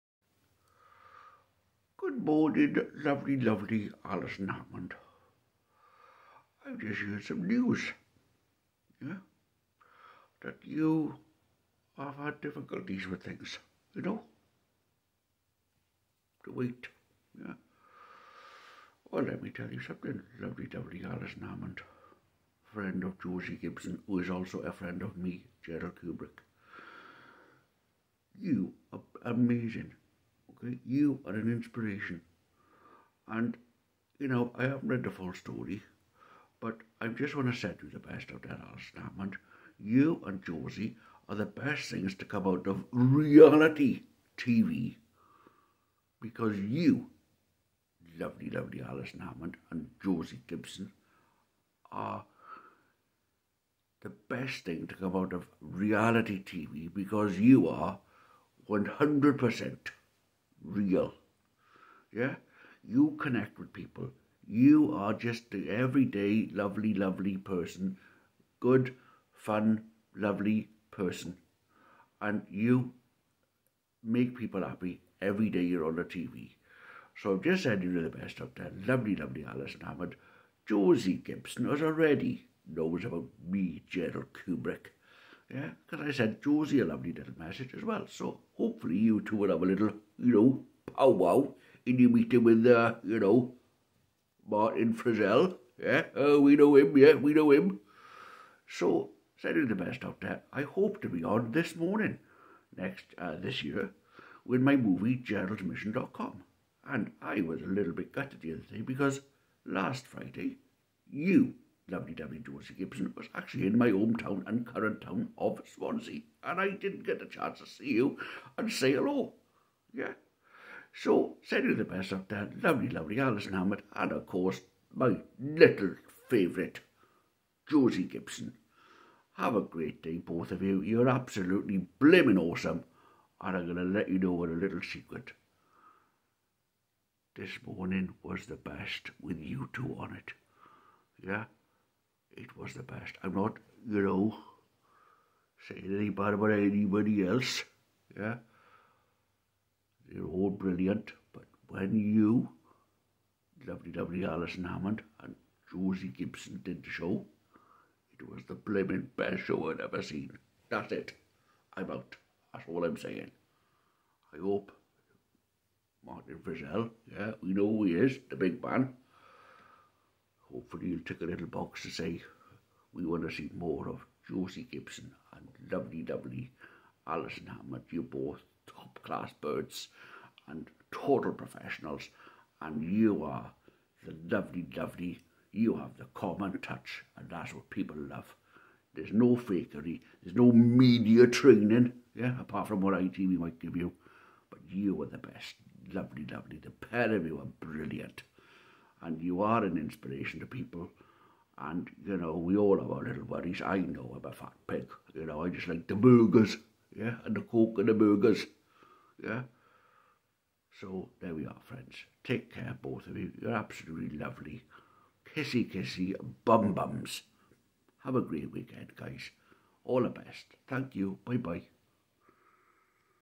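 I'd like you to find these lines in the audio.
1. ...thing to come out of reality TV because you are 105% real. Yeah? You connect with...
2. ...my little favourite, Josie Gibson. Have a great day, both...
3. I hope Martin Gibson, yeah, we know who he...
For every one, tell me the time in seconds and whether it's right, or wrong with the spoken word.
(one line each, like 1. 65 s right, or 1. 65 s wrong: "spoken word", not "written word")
1. 54 s wrong: "100", not "105"
2. 124 s right
3. 164 s wrong: "Frizzell", not "Gibson".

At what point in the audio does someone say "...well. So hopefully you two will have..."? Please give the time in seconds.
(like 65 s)
87 s.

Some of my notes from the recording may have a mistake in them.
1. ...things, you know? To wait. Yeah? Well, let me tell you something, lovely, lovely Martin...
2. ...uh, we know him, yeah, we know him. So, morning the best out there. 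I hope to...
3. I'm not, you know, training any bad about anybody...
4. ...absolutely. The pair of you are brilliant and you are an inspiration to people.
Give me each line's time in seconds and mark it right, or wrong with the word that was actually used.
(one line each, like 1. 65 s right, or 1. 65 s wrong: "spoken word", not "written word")
1. 13 s wrong: "Alison", not "Martin"
2. 96 s wrong: "sending", not "morning"
3. 143 s wrong: "saying", not "training"
4. 196 s wrong: "lovely", not "absolutely".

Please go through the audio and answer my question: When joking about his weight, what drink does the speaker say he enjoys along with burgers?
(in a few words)
Coke.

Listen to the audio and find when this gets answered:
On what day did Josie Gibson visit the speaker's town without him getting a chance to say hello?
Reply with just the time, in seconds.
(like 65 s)
109 s.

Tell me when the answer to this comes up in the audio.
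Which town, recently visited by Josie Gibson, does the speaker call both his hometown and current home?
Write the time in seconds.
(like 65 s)
115 s.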